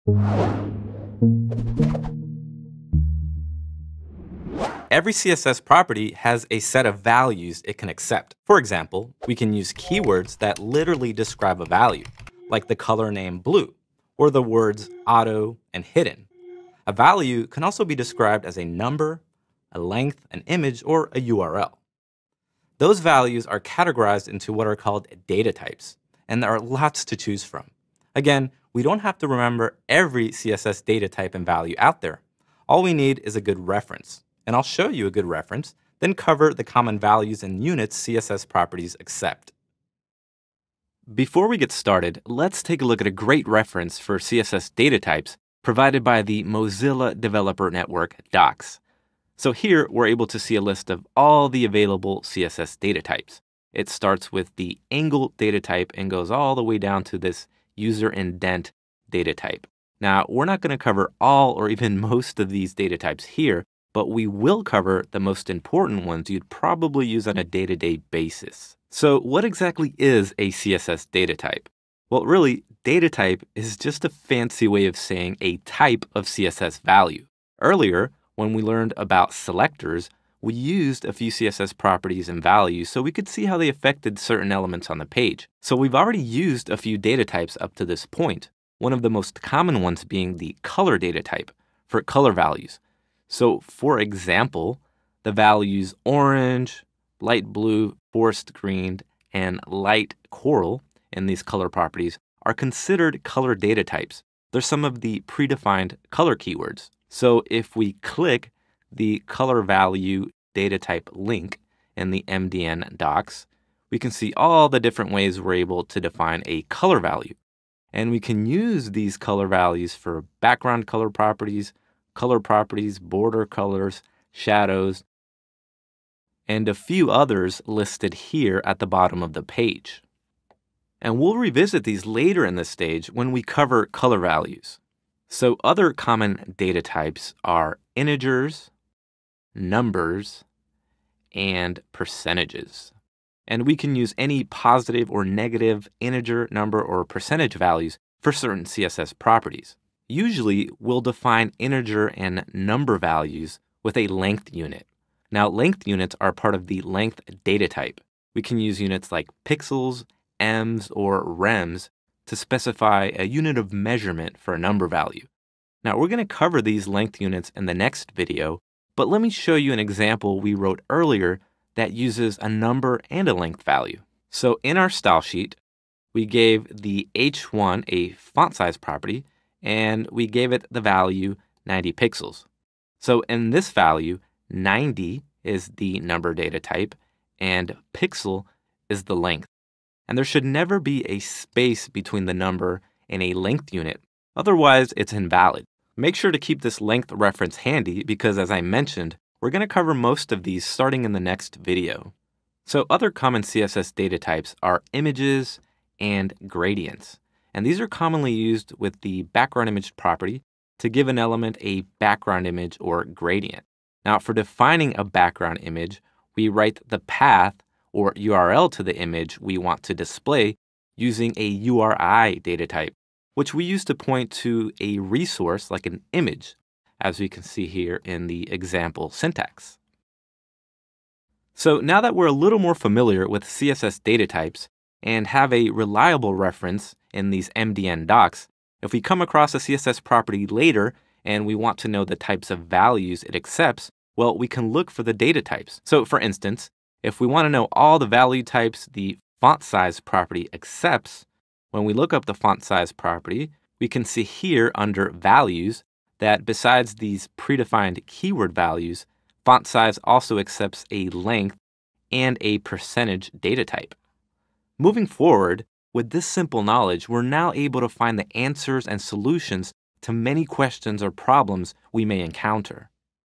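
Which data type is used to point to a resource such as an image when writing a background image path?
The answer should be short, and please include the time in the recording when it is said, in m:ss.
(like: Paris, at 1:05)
URI data type, at 3:41.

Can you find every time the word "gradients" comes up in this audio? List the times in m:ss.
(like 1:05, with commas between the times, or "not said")
3:26, 3:33.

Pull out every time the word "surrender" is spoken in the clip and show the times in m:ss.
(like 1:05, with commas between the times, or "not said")
not said.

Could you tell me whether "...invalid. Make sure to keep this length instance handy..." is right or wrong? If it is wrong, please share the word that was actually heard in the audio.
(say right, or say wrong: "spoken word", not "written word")
wrong: "reference", not "instance".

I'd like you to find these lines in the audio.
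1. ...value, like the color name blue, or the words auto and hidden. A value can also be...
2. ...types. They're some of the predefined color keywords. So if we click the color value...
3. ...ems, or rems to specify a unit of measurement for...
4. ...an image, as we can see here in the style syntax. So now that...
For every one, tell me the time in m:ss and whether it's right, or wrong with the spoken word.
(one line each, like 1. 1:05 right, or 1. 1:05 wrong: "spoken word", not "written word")
1. 0:11 right
2. 1:43 right
3. 2:40 right
4. 3:45 wrong: "example", not "style".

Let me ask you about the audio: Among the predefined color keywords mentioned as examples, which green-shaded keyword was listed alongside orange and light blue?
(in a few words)
forest green.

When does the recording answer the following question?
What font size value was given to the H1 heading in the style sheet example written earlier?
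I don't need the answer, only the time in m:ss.
3:01.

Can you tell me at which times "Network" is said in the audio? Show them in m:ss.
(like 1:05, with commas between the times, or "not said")
0:47.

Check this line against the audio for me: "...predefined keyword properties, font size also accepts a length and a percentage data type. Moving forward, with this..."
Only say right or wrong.
wrong.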